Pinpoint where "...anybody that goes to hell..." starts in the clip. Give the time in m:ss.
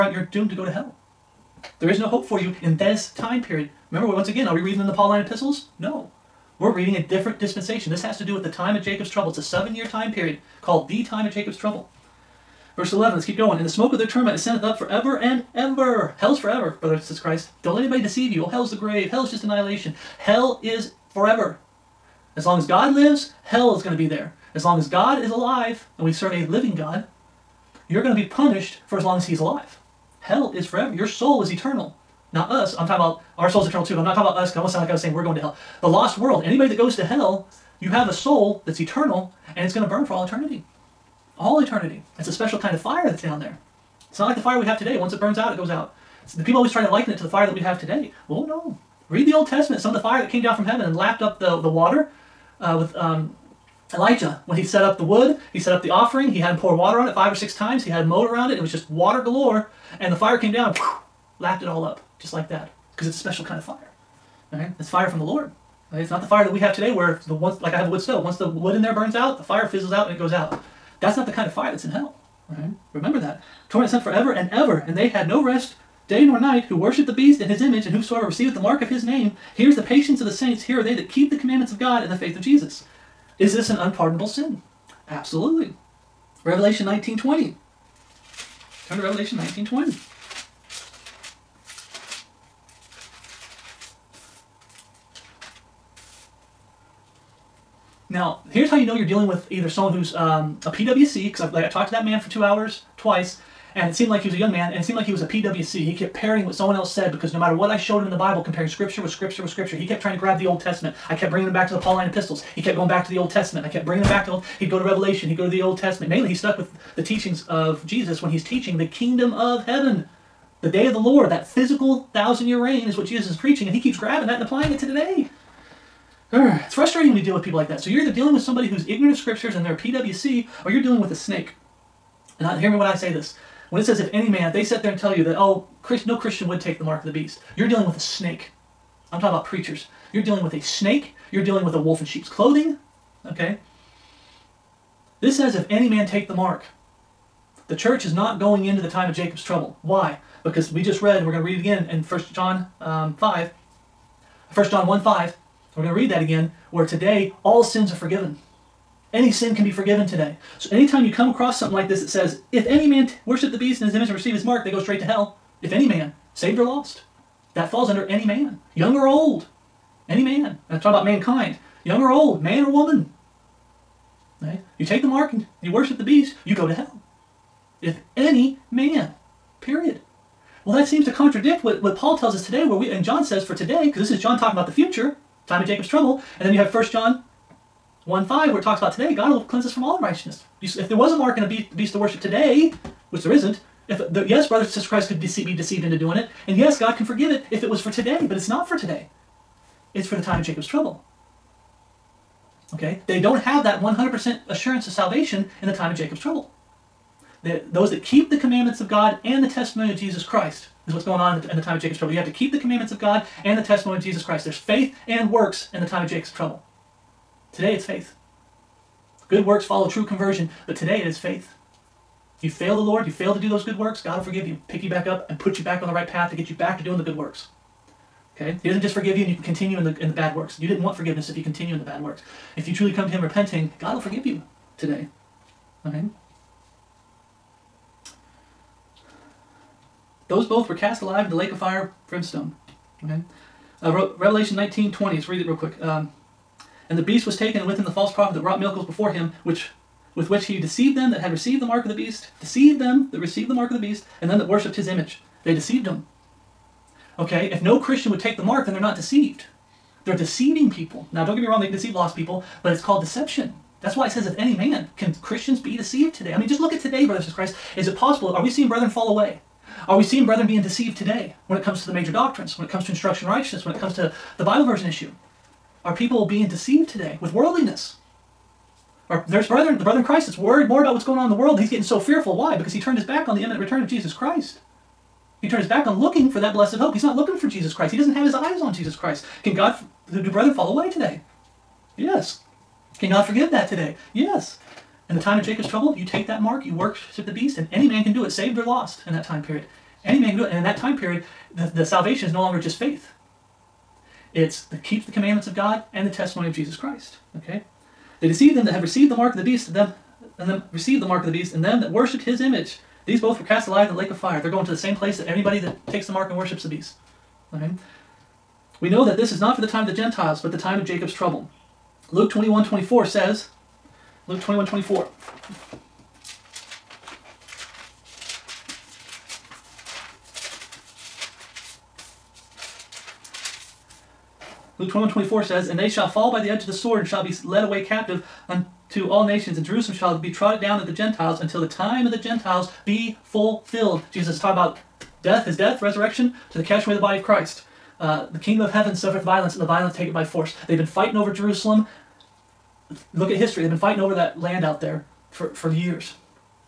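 0:36.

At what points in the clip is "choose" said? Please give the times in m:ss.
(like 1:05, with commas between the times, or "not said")
not said.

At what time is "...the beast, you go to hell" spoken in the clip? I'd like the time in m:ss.
2:55.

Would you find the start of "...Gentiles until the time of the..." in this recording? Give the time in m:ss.
5:40.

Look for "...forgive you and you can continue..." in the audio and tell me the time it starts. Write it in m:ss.
3:48.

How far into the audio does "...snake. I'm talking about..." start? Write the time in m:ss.
2:17.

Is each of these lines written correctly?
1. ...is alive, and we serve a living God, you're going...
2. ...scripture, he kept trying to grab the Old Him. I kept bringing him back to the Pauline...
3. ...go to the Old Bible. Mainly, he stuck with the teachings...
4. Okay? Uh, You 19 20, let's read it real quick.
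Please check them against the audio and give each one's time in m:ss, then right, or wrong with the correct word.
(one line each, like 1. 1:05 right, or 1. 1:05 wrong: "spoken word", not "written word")
1. 0:25 right
2. 1:49 wrong: "Testament", not "Him"
3. 1:55 wrong: "Testament", not "Bible"
4. 4:03 wrong: "Revelation", not "You".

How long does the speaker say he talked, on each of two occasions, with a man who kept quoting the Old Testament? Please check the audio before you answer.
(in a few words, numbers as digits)
2 hours.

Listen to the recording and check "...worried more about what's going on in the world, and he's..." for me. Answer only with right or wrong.
right.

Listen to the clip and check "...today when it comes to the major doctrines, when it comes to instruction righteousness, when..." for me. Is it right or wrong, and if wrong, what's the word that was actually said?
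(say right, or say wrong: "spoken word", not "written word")
right.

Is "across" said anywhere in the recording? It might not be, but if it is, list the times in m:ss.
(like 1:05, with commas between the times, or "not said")
2:41.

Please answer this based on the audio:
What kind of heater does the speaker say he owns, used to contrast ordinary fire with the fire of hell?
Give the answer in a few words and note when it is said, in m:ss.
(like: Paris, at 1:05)
Wood stove, at 1:07.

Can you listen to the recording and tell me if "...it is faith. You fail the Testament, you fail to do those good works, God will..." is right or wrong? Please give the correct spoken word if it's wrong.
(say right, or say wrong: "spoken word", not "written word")
wrong: "Lord", not "Testament".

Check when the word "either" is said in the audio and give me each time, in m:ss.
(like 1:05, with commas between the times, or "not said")
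1:39, 2:08.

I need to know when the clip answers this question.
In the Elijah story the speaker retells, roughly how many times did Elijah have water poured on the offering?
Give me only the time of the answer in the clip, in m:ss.
0:57.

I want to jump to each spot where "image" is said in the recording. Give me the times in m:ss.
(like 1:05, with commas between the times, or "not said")
1:17, 2:43, 4:14, 5:12.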